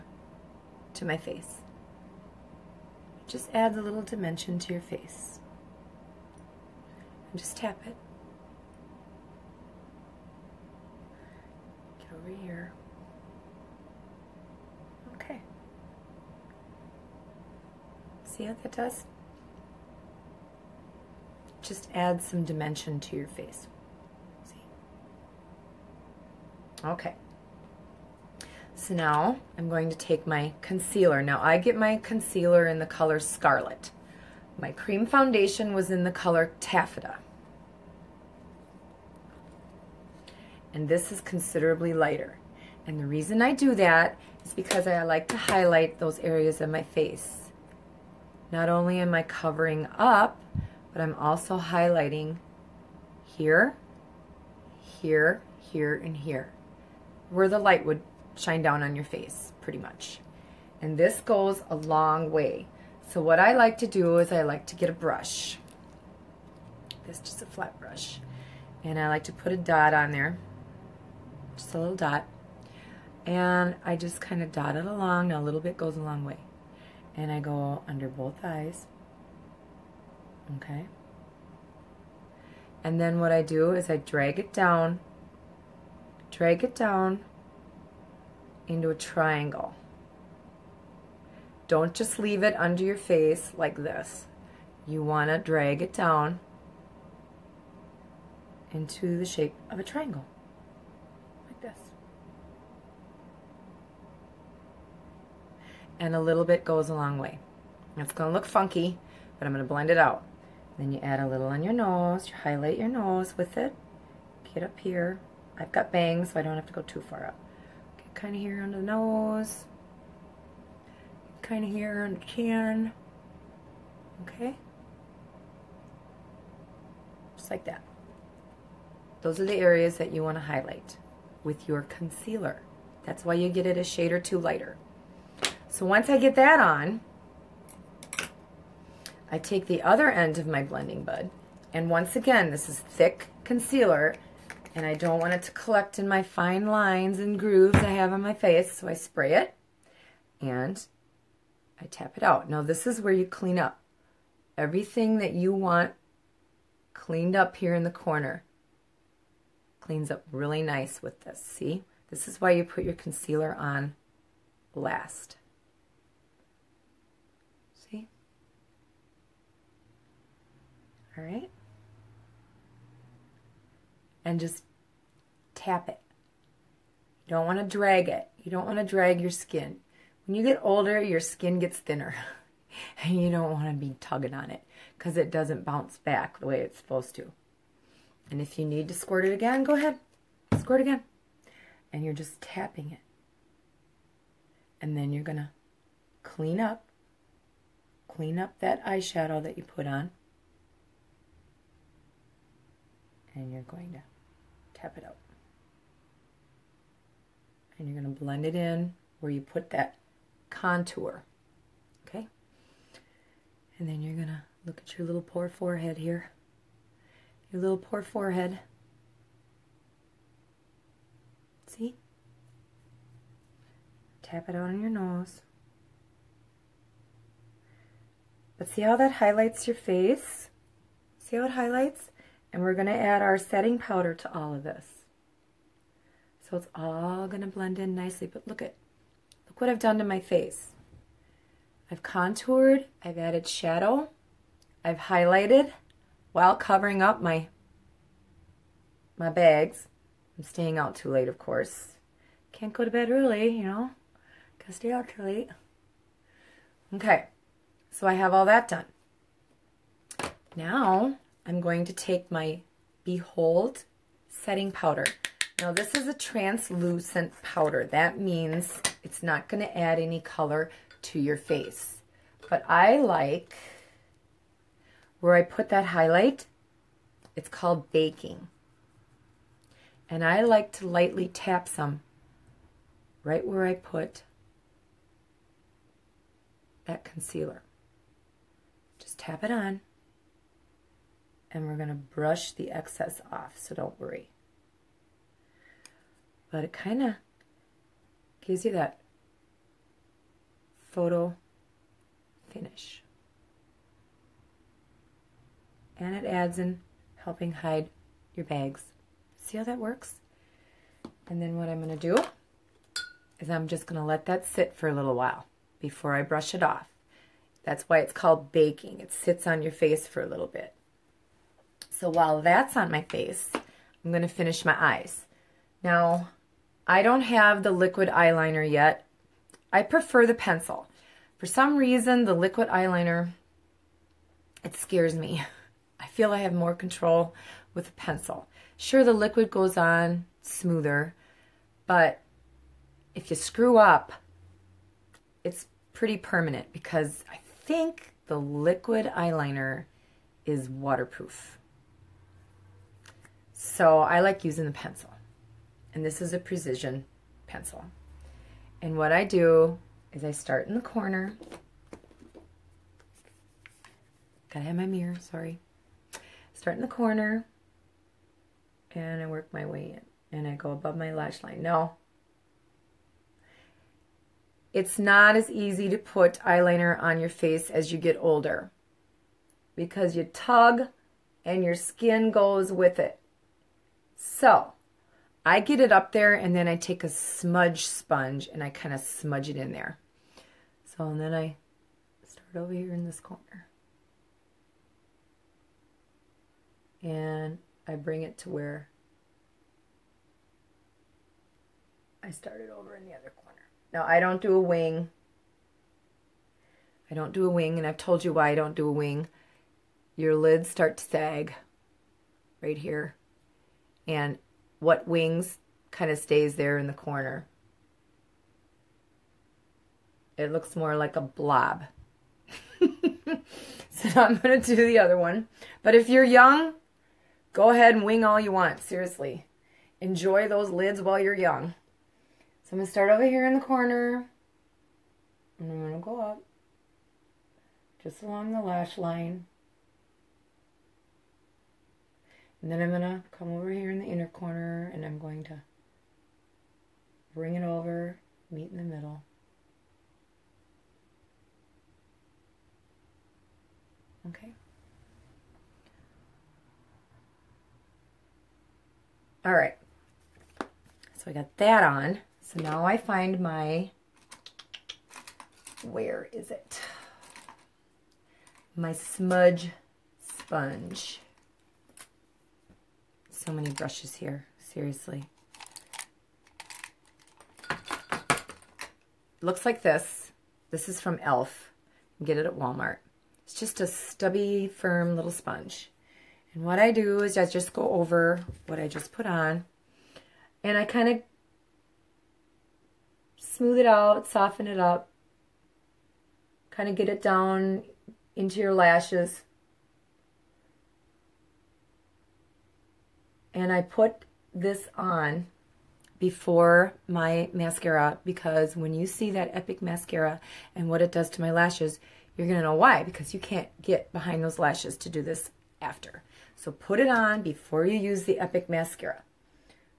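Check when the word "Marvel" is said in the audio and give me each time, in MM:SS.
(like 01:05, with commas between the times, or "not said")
not said.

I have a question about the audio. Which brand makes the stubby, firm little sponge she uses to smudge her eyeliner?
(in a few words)
e.l.f.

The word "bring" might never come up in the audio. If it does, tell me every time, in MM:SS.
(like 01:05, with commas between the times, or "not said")
06:37, 07:27.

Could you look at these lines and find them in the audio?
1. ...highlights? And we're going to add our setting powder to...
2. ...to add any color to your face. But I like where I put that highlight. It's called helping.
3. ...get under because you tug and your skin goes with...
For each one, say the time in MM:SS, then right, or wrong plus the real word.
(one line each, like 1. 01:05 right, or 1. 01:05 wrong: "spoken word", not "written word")
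1. 03:51 right
2. 04:29 wrong: "baking", not "helping"
3. 06:17 wrong: "older", not "under".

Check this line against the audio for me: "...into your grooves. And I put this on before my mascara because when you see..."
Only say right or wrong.
wrong.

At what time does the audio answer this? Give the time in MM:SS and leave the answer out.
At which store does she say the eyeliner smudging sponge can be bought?
08:02.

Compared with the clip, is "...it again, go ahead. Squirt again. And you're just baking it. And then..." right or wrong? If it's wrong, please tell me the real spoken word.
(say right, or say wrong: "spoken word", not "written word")
wrong: "tapping", not "baking".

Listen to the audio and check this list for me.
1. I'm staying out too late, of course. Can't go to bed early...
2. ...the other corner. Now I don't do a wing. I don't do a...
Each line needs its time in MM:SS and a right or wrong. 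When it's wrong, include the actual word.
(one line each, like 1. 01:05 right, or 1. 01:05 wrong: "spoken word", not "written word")
1. 04:10 right
2. 06:43 right.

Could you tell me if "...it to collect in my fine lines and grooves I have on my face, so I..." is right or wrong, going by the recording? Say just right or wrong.
right.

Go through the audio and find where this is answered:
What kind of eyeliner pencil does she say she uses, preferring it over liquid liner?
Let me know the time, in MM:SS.
05:56.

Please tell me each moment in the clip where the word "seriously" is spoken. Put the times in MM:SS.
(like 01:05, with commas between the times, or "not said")
07:08, 07:54.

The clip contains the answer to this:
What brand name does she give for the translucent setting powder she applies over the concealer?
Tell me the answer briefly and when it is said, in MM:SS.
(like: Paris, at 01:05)
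Behold, at 04:23.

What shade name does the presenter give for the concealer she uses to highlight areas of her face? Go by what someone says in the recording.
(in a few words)
Scarlet.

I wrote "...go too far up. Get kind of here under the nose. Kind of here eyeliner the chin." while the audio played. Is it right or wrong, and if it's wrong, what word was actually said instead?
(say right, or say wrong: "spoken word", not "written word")
wrong: "under", not "eyeliner".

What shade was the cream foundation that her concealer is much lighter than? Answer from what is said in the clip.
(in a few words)
Taffeta.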